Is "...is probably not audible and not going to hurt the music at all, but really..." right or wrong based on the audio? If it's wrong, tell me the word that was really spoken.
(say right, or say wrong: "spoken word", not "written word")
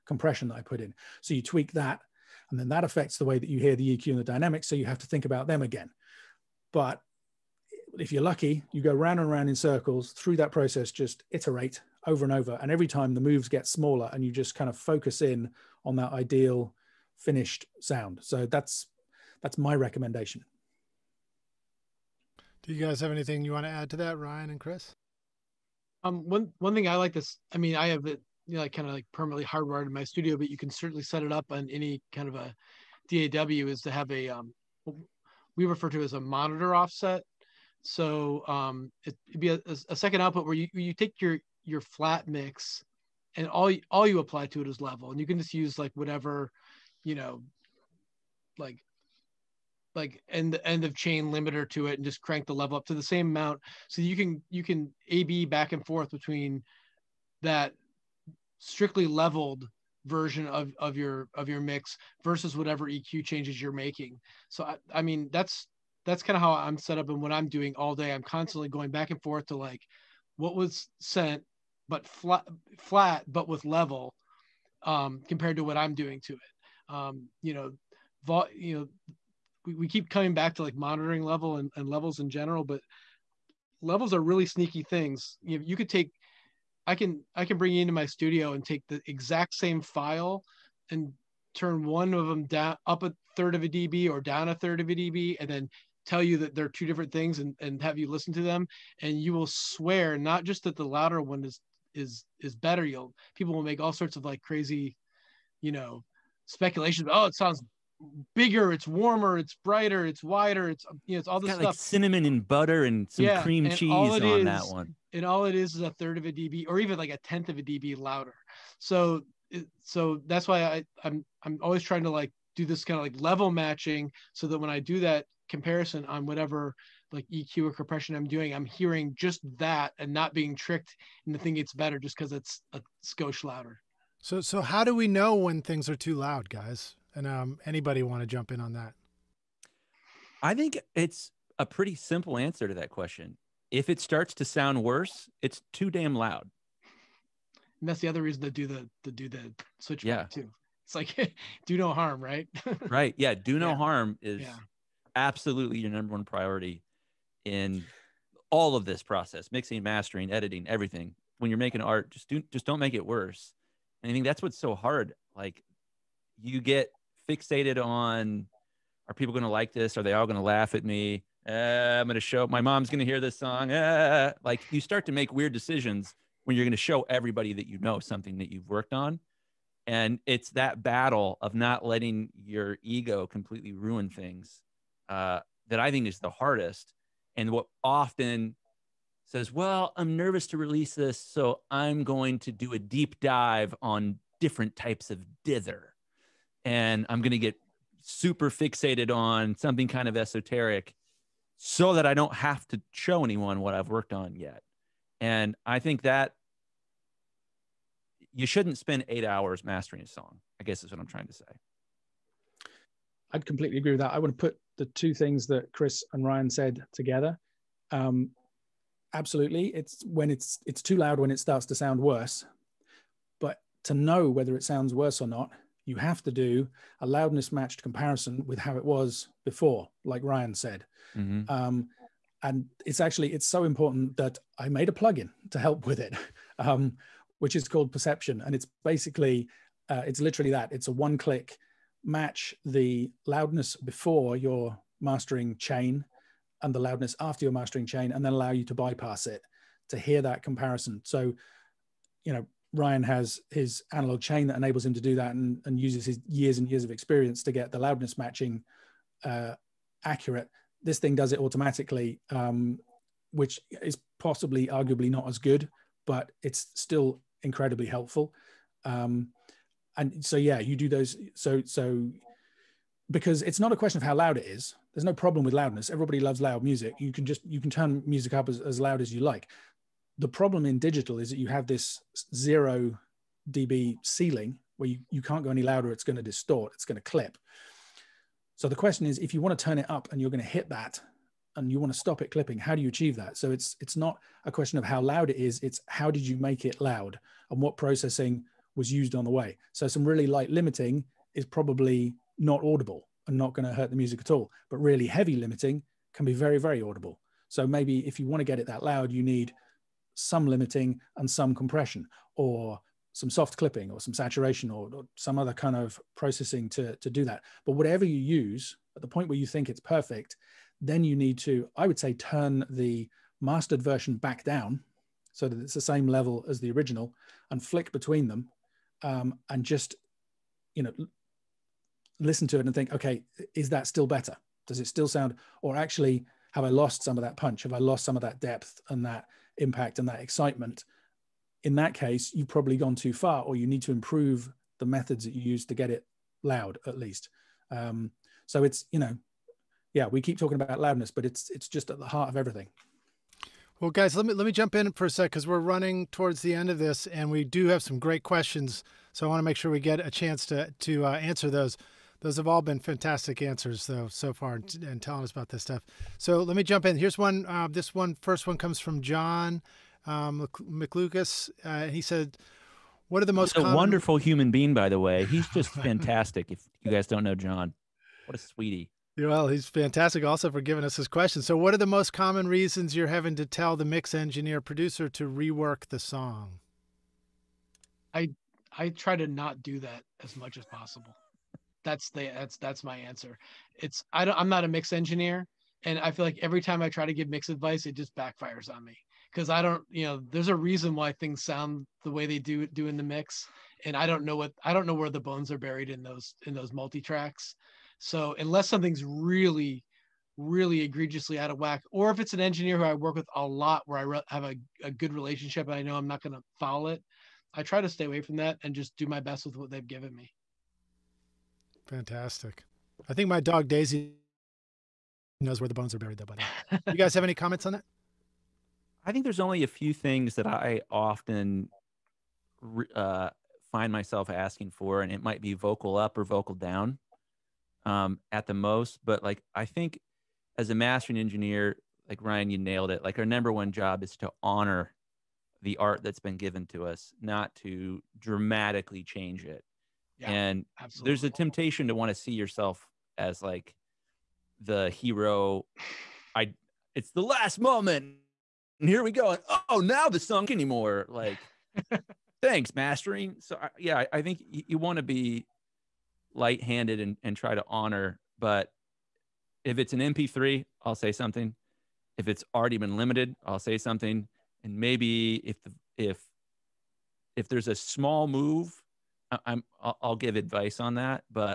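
right.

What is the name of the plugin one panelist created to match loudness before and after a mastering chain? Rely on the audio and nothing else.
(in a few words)
Perception.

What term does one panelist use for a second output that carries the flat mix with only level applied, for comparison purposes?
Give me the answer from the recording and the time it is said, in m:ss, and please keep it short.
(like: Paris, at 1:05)
monitor offset, at 0:36.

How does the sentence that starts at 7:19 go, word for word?
But like, I think as a mastering engineer, like Ryan, you nailed it.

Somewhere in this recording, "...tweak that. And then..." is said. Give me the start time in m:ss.
0:01.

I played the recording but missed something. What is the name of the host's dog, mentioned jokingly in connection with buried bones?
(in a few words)
Daisy.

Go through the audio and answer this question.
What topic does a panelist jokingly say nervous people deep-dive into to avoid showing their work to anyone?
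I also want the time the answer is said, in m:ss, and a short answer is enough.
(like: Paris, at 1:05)
dither, at 3:15.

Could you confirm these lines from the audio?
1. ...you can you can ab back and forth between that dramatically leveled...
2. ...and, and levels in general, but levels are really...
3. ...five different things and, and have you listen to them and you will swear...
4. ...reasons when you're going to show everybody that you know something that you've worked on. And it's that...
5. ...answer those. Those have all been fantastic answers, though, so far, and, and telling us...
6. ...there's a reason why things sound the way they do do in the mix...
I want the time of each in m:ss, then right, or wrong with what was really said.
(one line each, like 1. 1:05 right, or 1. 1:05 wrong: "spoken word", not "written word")
1. 0:54 wrong: "strictly", not "dramatically"
2. 1:21 right
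3. 1:36 wrong: "two", not "five"
4. 2:55 wrong: "decisions", not "reasons"
5. 6:01 right
6. 6:40 right.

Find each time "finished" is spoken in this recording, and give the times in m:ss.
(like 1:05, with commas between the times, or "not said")
0:17.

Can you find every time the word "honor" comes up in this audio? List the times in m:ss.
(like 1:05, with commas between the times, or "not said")
7:24, 7:47.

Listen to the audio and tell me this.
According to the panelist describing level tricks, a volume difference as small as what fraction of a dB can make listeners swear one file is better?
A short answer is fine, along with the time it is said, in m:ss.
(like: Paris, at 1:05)
a tenth of a dB, at 1:57.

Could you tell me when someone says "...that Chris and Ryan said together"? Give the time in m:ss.
3:35.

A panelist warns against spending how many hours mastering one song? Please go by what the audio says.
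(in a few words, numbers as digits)
8.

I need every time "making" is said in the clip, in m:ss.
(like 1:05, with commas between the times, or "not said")
1:03, 2:41.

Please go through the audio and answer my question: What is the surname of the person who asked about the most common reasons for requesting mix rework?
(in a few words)
McLucas.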